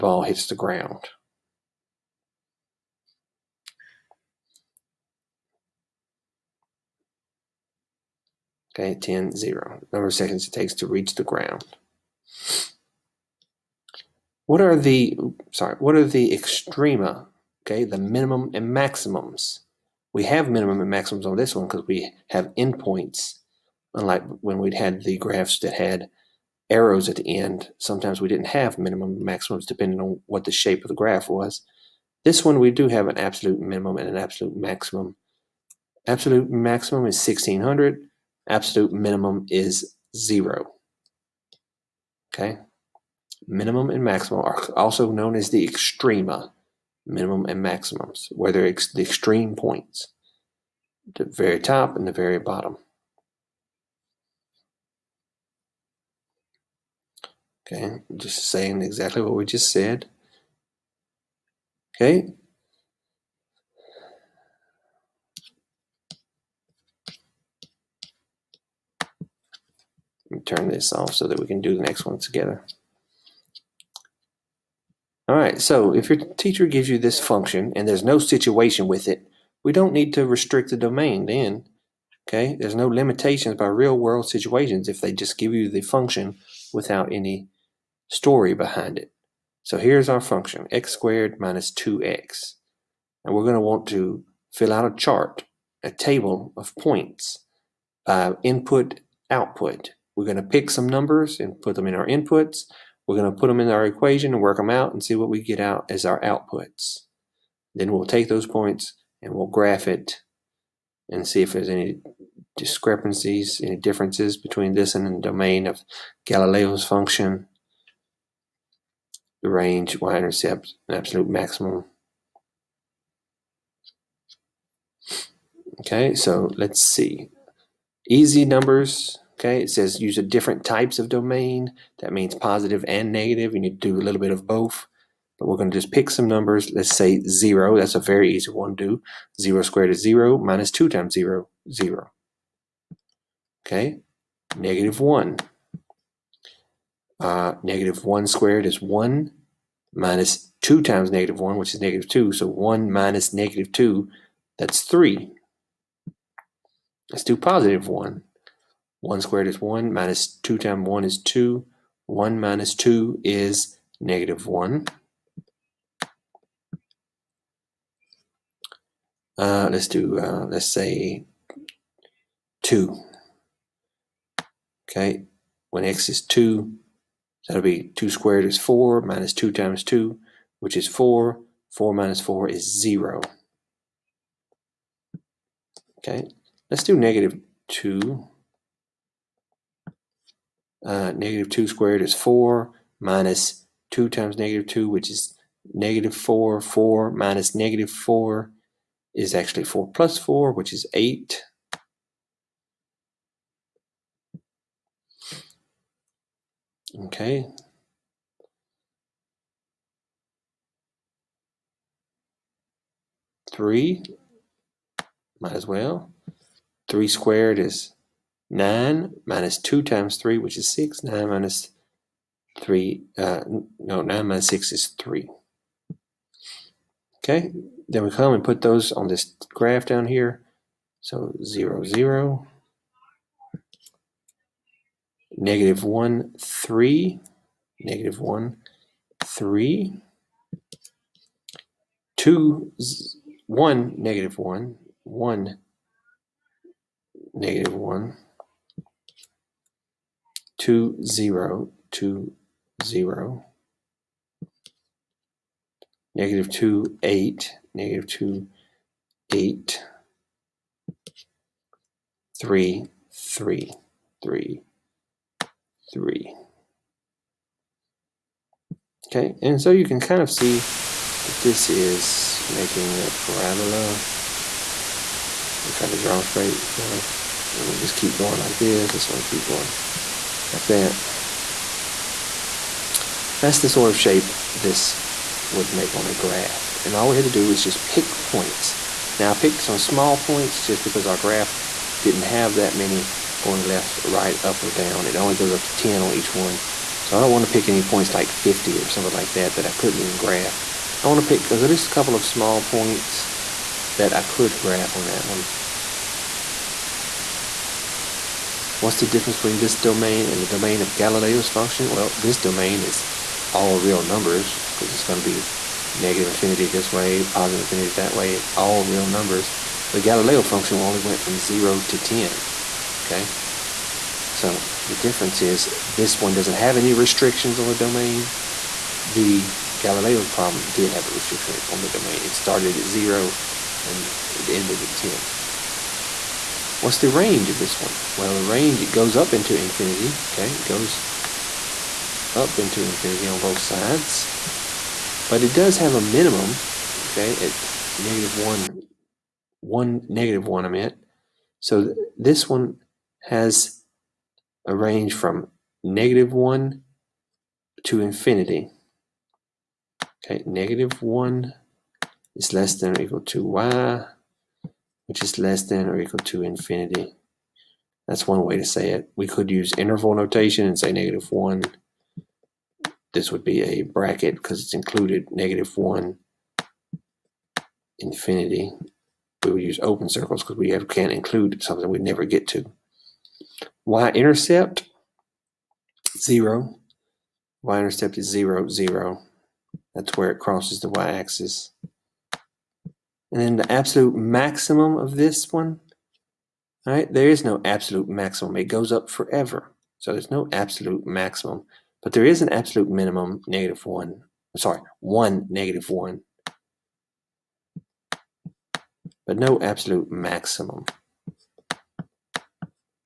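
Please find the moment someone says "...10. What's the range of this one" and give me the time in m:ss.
5:34.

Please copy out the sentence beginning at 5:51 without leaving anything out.
So th this one has a range from negative 1 to infinity.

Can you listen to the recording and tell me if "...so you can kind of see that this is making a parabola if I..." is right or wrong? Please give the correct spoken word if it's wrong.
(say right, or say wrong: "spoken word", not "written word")
right.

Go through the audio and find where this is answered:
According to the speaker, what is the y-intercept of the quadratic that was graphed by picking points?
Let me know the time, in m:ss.
6:27.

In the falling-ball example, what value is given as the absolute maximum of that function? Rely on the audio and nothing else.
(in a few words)
1600.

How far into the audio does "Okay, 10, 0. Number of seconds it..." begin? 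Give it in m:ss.
0:08.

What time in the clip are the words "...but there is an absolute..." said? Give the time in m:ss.
6:42.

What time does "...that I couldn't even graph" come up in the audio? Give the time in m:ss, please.
4:59.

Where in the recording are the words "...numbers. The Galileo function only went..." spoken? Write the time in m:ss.
5:19.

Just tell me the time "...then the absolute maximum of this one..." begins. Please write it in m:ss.
6:33.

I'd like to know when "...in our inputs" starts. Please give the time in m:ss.
1:41.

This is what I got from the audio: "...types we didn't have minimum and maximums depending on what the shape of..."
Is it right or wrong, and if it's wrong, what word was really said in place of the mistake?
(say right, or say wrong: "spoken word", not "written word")
wrong: "sometimes", not "types".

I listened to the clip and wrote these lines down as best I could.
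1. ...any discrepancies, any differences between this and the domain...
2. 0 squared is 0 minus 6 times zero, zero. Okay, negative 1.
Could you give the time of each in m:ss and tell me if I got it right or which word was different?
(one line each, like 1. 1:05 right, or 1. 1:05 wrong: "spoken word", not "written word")
1. 1:51 right
2. 2:19 wrong: "2", not "6".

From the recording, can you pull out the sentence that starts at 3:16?
4 minus negative 4 is actually 4 plus 4, which is 8.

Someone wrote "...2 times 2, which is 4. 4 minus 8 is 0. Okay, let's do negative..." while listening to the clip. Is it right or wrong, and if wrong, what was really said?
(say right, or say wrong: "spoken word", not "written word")
wrong: "4", not "8".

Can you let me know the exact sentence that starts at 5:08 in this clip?
What's the difference between this domain and the domain of Galileo's function?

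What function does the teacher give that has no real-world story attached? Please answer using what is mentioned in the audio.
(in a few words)
x squared minus 2x.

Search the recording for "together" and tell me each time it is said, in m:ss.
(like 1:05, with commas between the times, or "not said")
1:12.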